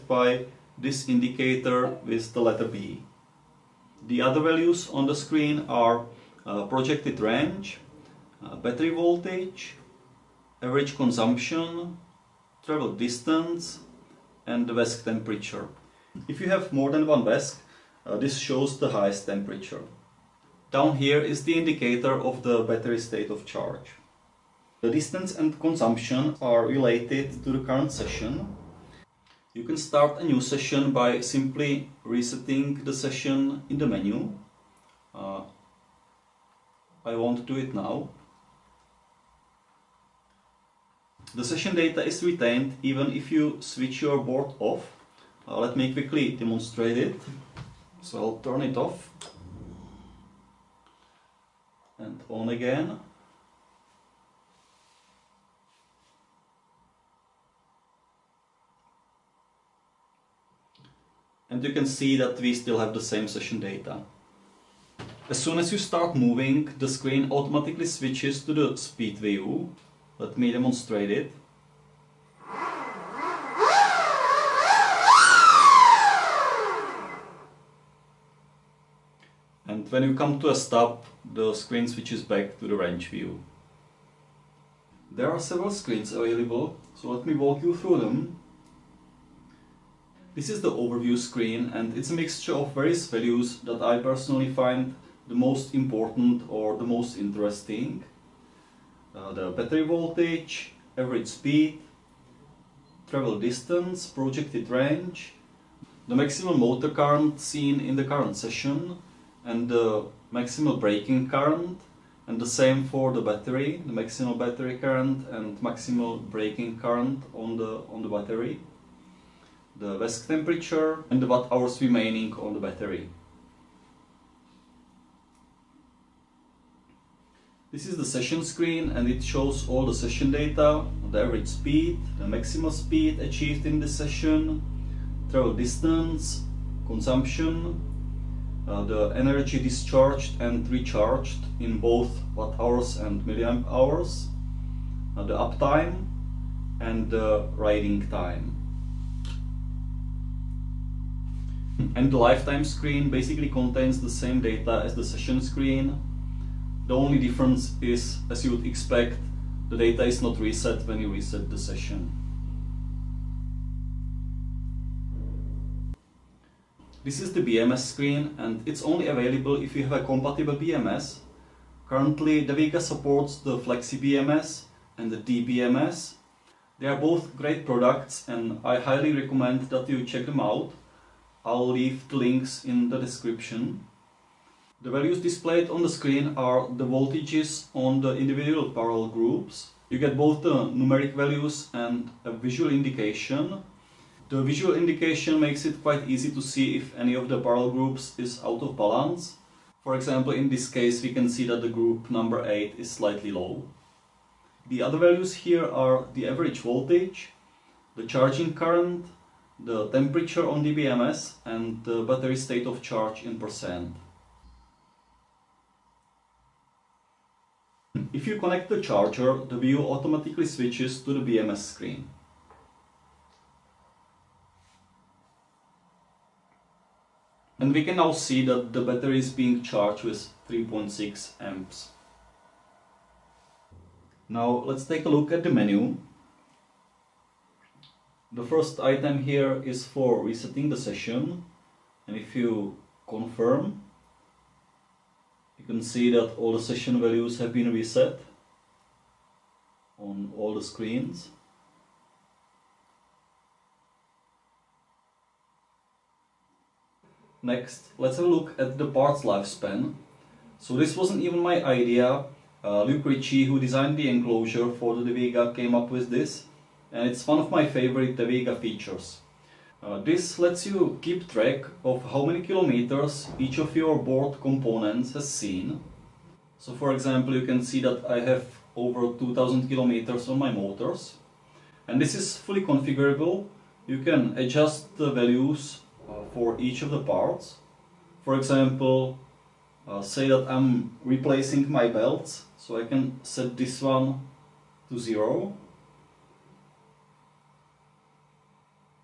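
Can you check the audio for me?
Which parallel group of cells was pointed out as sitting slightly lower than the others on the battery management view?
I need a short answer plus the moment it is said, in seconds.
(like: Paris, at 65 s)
8, at 202 s.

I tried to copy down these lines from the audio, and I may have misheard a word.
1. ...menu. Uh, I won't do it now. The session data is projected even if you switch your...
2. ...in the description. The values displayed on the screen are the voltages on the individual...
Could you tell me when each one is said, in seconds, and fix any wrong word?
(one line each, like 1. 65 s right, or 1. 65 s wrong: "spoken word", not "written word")
1. 33 s wrong: "retained", not "projected"
2. 182 s right.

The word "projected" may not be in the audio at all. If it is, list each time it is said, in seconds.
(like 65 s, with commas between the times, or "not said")
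6 s, 104 s.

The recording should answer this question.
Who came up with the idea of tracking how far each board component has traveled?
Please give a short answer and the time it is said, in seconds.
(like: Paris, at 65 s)
Luke Ritchie, at 262 s.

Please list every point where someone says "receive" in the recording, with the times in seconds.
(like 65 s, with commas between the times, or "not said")
not said.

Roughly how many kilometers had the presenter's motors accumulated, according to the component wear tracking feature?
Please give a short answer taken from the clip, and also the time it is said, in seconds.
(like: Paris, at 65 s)
2000 kilometers, at 279 s.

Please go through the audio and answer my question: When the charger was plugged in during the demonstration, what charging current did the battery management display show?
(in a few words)
3.6 amps.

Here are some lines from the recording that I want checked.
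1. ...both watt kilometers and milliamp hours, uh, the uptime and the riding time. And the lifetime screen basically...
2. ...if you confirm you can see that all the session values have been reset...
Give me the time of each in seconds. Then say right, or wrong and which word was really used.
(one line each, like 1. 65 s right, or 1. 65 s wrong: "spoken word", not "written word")
1. 141 s wrong: "hours", not "kilometers"
2. 242 s right.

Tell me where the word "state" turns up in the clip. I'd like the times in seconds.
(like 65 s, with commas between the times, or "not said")
22 s, 212 s.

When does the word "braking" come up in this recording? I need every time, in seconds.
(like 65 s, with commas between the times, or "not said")
110 s, 116 s.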